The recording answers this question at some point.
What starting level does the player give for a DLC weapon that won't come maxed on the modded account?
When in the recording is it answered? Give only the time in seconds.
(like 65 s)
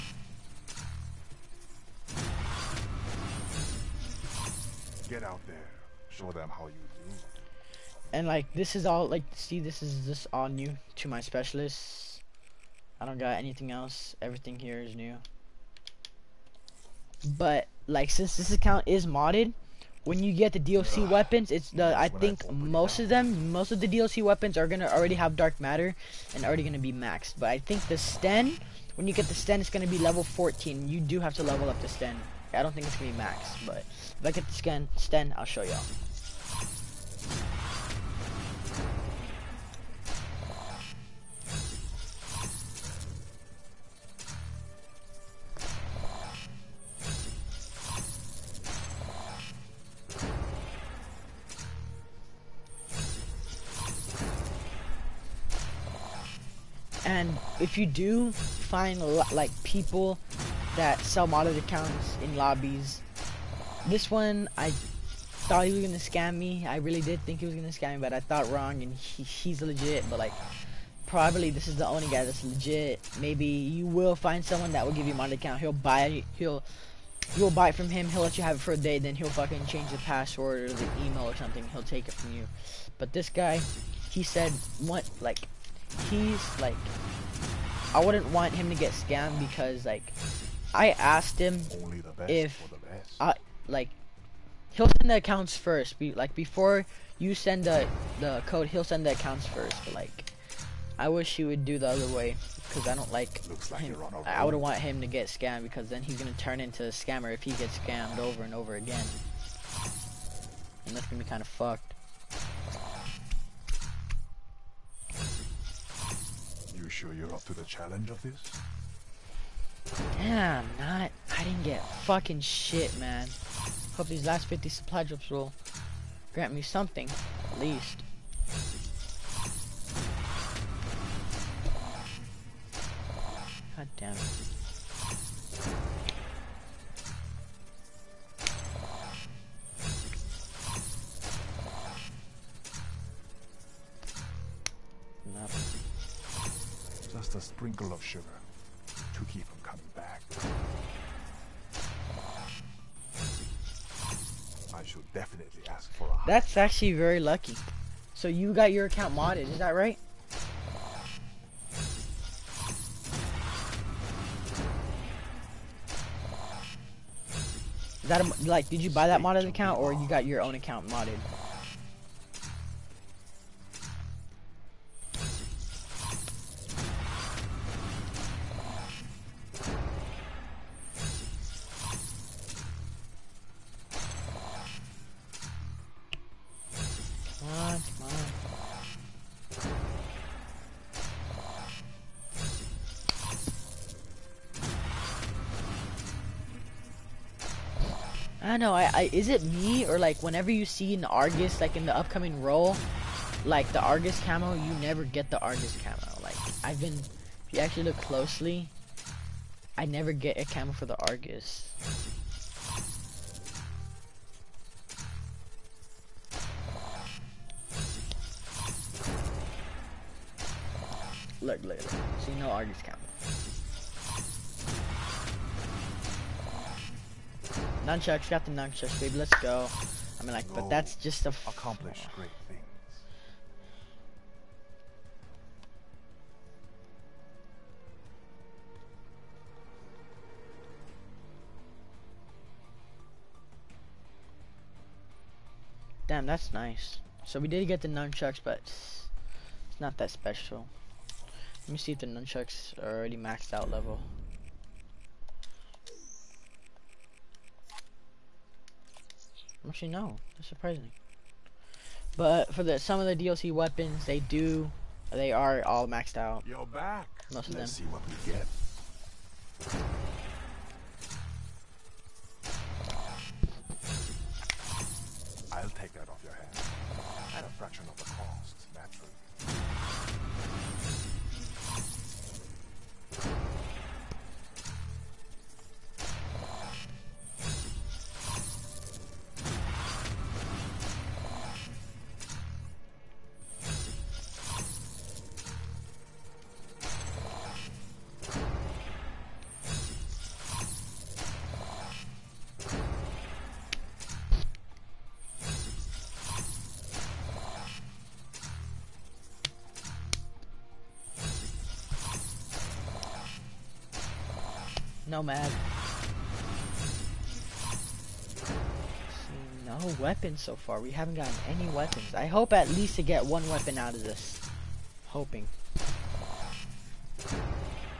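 29 s.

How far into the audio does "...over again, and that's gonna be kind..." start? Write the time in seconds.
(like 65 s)
108 s.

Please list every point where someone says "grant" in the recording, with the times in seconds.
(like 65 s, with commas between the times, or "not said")
126 s.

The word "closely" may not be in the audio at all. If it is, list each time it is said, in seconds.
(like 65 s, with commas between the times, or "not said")
207 s.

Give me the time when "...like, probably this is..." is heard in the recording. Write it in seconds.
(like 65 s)
70 s.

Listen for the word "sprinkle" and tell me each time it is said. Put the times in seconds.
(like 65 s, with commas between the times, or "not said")
147 s.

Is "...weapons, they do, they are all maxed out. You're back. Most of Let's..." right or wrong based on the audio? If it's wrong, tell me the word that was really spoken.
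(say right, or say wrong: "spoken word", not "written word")
right.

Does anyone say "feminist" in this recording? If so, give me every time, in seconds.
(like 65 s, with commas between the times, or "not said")
not said.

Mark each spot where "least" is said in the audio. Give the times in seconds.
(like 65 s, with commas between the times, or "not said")
127 s, 322 s.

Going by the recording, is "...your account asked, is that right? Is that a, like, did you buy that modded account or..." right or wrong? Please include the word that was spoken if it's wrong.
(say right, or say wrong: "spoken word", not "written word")
wrong: "modded", not "asked".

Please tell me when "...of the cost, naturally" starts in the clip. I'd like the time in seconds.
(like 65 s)
277 s.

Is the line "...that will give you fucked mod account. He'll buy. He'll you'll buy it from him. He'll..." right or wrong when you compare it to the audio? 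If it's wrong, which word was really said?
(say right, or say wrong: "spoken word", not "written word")
wrong: "modded", not "fucked".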